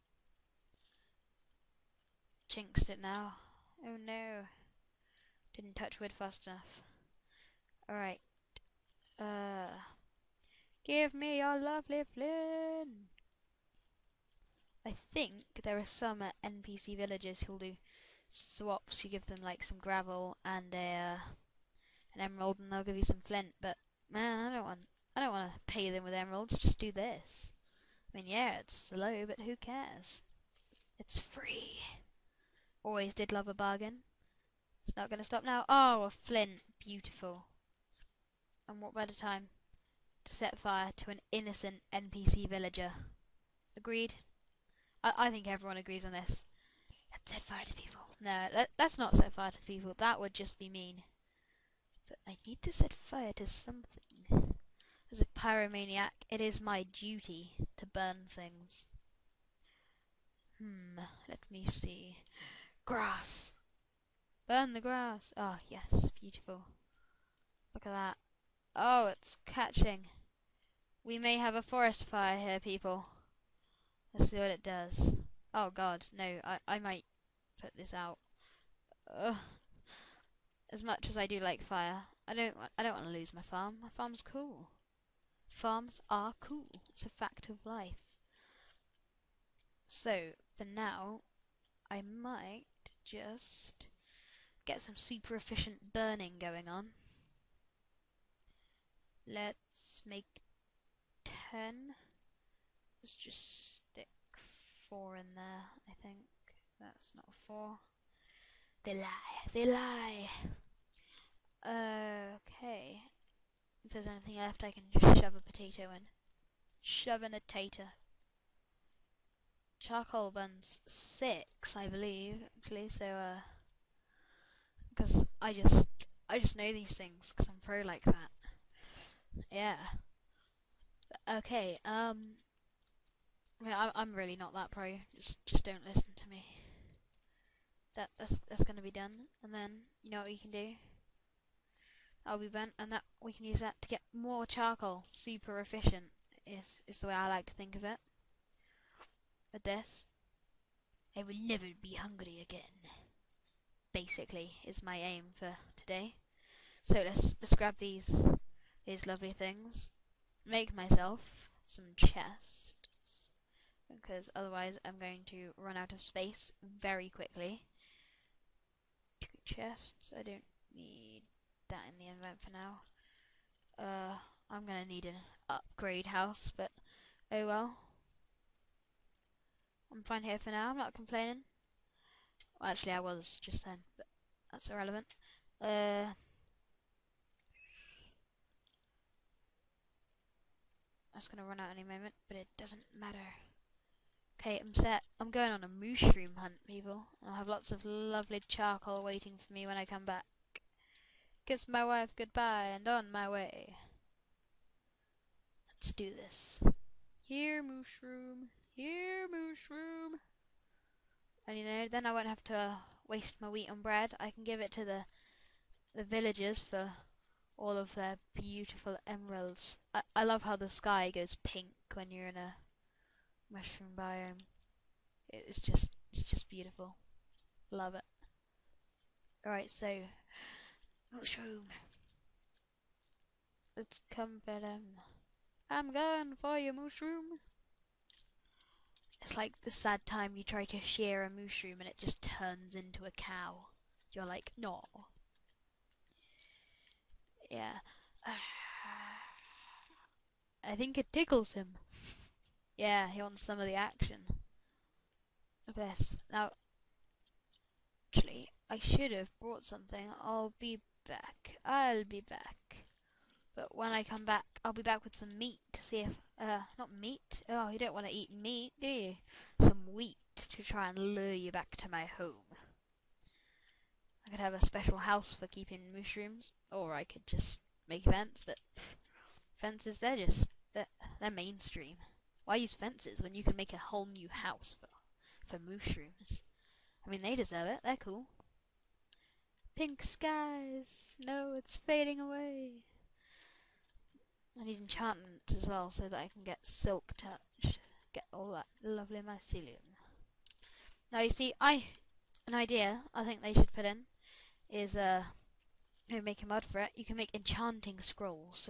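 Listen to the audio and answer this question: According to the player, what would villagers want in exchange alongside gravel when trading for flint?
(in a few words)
an emerald.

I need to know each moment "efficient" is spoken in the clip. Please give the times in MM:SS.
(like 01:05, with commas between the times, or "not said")
01:35, 02:25.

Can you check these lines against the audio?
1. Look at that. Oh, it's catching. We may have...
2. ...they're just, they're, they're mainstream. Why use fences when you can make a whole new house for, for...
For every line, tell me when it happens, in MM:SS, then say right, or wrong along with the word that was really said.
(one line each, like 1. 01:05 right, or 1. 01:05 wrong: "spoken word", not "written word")
1. 01:07 right
2. 04:39 right.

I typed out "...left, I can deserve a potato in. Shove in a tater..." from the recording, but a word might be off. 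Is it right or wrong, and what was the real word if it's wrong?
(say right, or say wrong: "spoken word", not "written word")
wrong: "shove", not "deserve".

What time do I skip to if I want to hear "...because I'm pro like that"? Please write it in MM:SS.
02:07.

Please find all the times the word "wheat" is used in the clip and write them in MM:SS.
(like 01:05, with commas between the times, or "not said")
03:33, 04:29.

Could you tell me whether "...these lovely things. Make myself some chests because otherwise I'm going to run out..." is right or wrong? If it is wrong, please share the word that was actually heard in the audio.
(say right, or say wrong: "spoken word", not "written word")
right.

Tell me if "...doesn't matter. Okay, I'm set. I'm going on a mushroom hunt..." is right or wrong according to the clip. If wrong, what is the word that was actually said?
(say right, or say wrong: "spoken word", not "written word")
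right.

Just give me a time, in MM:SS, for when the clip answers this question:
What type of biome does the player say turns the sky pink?
03:43.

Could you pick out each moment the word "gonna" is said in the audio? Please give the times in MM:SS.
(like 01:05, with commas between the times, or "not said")
02:18, 02:54, 03:11.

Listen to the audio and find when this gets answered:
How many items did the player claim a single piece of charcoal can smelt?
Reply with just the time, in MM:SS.
02:00.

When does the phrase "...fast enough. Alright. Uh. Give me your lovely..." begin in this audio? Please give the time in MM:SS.
00:06.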